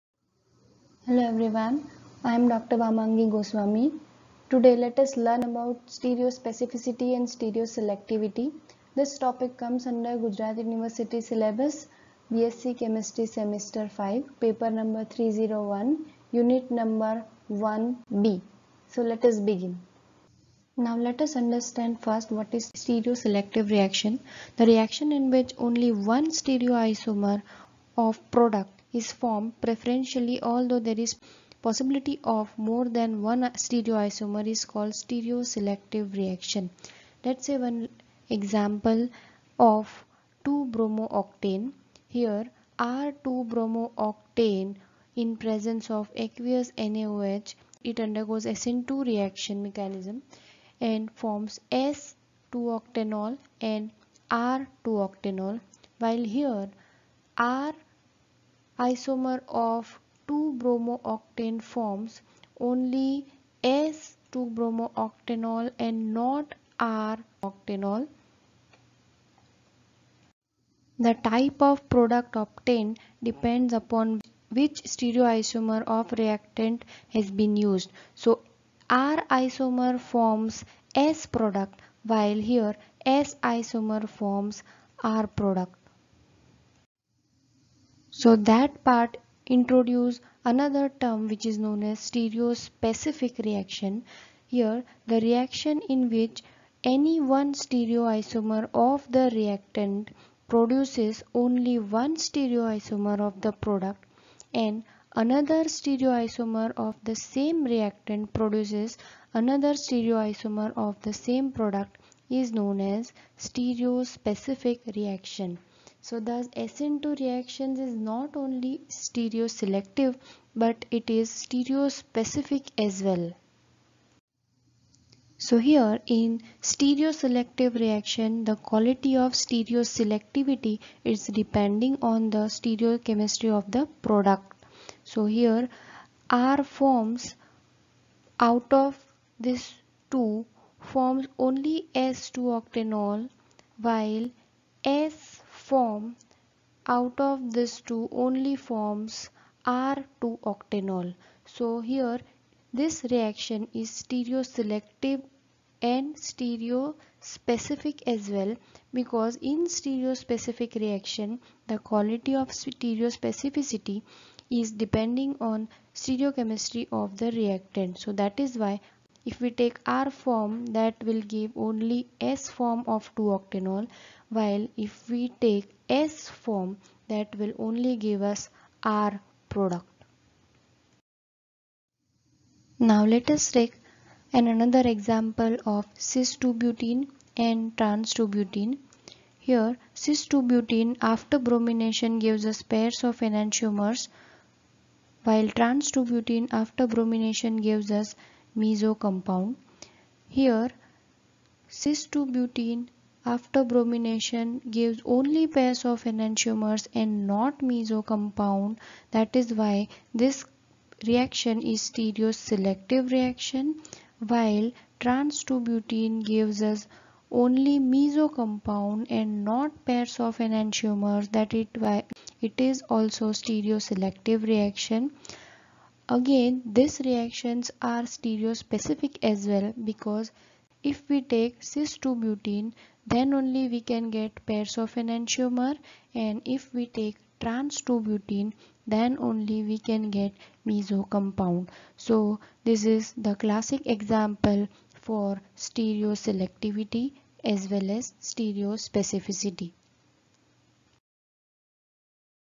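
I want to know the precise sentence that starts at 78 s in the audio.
So R isomer forms S product while here S isomer forms R product.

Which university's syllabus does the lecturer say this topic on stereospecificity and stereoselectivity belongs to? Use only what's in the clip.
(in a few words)
Gujarat University.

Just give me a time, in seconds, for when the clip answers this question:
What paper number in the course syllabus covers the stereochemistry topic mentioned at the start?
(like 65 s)
15 s.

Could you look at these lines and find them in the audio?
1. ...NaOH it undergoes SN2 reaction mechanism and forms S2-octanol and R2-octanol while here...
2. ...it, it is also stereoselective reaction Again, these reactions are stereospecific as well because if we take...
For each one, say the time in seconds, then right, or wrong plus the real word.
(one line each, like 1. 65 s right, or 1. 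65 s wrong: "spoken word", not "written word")
1. 46 s right
2. 221 s right.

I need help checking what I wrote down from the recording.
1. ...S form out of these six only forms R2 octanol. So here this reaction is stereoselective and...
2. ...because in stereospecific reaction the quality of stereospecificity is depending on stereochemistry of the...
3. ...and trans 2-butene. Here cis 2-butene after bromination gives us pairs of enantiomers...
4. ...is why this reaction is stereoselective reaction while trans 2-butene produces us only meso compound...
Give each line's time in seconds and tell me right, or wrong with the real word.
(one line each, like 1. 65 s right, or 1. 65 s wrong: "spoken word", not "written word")
1. 144 s wrong: "two", not "six"
2. 158 s right
3. 187 s right
4. 209 s wrong: "gives", not "produces".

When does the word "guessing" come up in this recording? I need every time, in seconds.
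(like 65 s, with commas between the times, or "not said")
not said.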